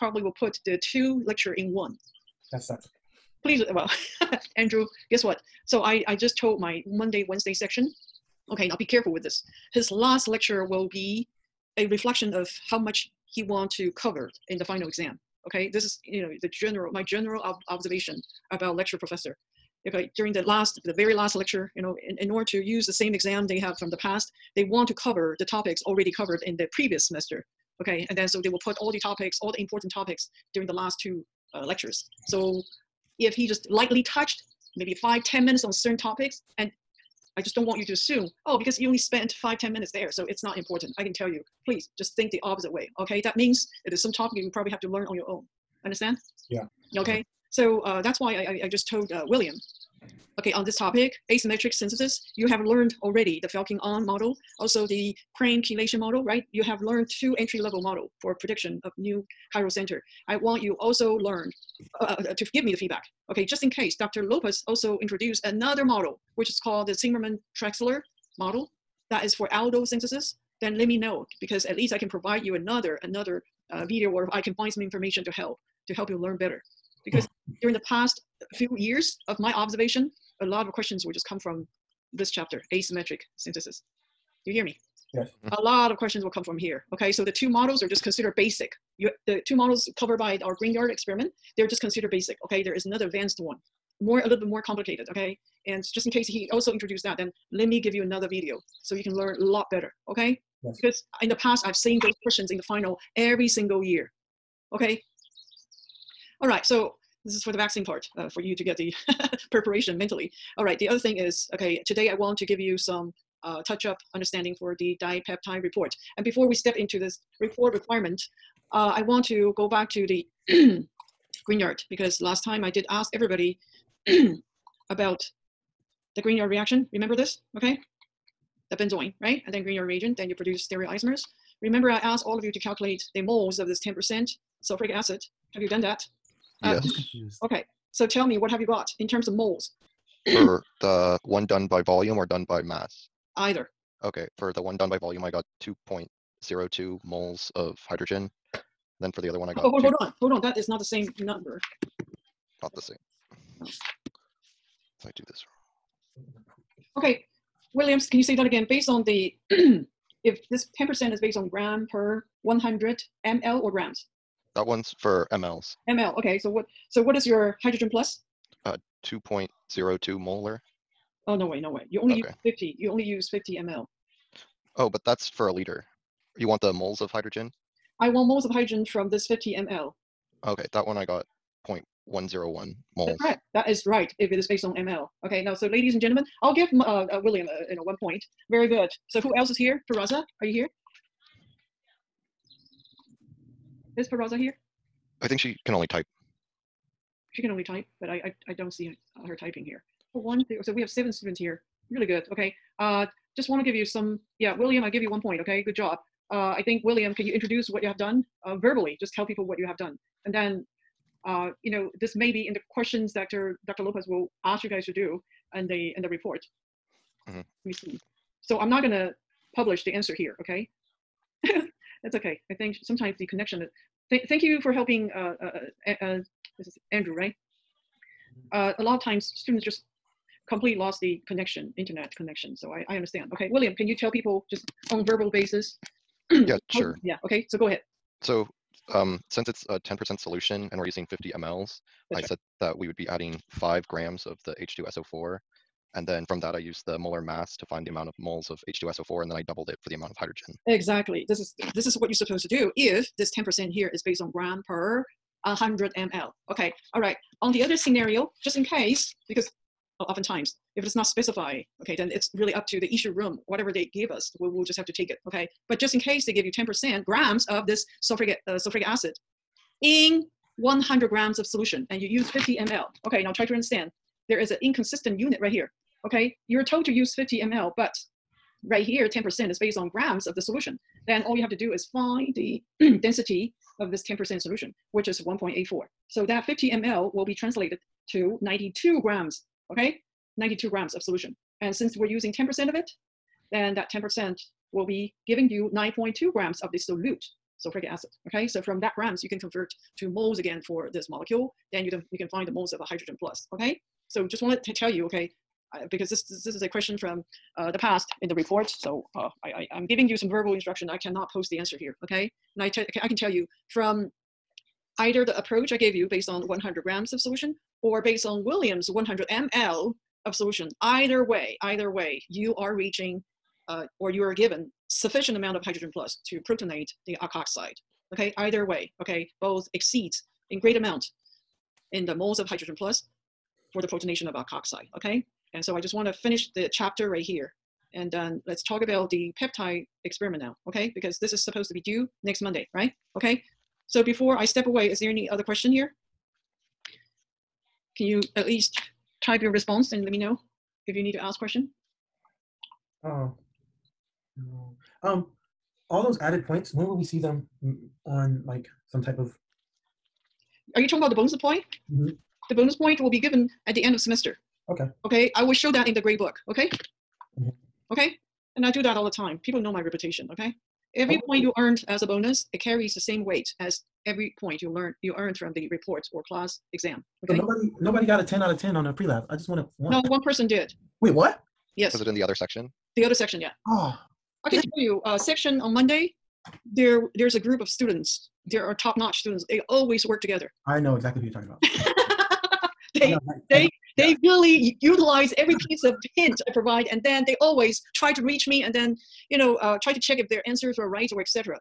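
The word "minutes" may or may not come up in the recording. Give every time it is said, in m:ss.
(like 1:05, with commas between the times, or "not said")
0:35, 0:39.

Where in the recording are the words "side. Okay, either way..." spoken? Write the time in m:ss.
5:27.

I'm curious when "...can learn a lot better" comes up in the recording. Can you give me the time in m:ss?
1:39.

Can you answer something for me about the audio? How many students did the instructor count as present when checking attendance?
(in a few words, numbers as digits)
7.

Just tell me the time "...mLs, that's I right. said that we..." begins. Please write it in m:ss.
4:01.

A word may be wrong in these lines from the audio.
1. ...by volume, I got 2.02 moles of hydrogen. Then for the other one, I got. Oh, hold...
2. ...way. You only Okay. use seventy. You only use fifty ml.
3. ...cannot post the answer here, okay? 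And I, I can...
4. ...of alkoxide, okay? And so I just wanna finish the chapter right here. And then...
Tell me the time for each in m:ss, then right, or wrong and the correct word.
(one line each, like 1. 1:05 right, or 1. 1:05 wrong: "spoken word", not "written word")
1. 2:24 right
2. 2:51 wrong: "fifty", not "seventy"
3. 5:10 right
4. 5:34 right.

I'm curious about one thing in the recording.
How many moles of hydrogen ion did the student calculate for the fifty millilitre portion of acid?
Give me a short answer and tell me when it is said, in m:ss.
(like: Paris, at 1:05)
0.101 moles, at 3:01.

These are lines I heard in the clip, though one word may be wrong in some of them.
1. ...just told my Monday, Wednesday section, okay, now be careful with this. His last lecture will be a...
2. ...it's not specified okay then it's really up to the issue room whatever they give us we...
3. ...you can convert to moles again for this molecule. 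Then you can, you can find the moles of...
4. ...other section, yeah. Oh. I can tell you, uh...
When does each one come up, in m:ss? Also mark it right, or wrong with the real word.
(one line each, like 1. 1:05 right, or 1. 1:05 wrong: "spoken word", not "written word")
1. 0:06 right
2. 4:20 right
3. 4:59 right
4. 6:23 right.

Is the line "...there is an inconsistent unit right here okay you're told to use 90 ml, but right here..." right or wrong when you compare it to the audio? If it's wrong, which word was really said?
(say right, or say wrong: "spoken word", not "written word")
wrong: "50", not "90".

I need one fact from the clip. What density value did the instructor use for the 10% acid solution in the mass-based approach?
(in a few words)
1.84.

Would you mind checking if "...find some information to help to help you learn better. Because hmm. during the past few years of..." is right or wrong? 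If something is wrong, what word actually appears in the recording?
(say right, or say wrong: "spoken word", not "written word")
right.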